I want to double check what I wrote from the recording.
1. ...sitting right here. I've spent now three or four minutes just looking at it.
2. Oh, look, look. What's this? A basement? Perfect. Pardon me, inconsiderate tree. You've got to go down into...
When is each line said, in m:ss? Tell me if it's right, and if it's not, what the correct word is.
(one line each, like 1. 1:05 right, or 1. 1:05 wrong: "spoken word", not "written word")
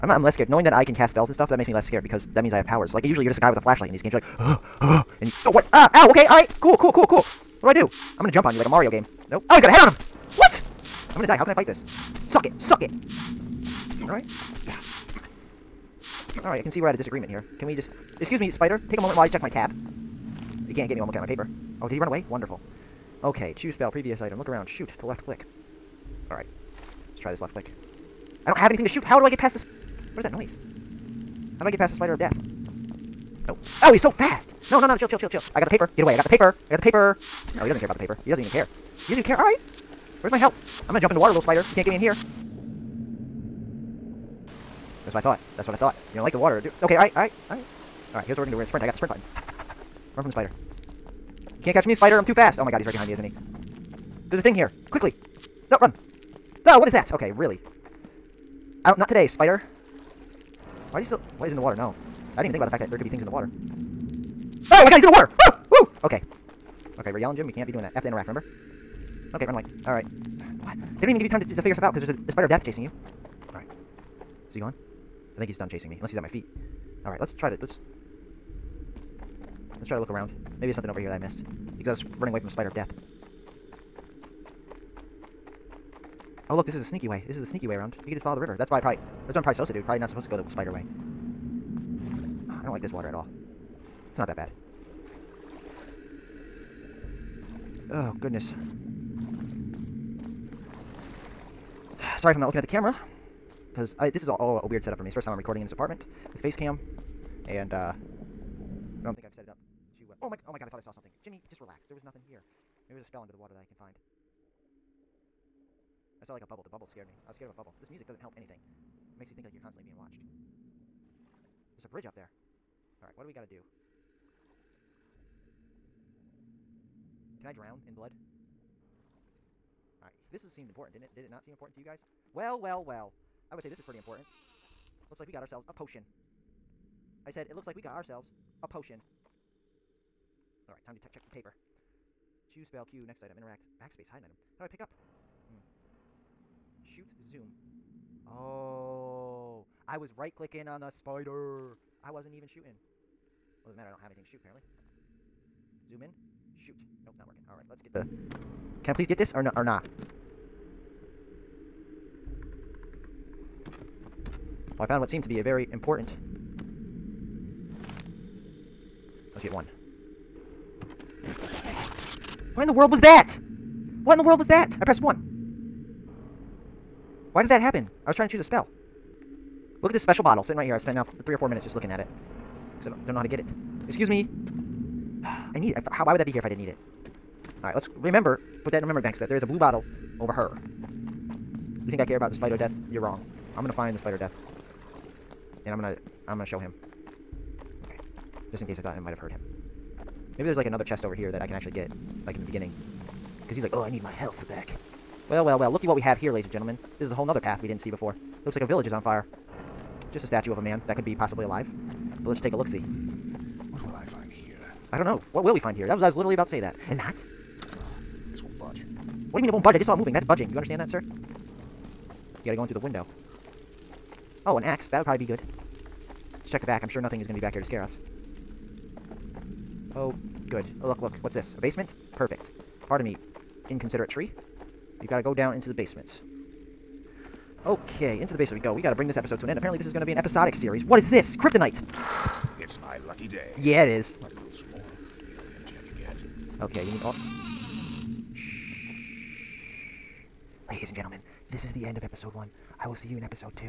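1. 3:00 right
2. 3:50 right.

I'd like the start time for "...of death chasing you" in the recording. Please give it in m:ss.
1:12.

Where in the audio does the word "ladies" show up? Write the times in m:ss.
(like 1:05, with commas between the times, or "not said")
3:26, 4:10.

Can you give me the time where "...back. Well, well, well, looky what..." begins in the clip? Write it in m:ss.
3:24.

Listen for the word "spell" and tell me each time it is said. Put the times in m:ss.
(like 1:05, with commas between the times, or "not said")
0:01, 0:23, 1:53, 2:22, 2:58.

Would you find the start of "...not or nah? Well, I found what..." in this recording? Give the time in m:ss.
2:39.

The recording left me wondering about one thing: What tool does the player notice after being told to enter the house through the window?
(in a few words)
An axe.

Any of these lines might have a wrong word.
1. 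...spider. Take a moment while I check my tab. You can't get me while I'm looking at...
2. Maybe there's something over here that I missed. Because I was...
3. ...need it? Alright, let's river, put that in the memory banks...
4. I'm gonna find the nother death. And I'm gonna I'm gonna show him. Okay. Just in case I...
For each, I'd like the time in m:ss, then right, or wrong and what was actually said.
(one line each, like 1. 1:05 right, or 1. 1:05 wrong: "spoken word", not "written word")
1. 0:18 right
2. 1:20 right
3. 3:06 wrong: "remember", not "river"
4. 3:13 wrong: "spider", not "nother".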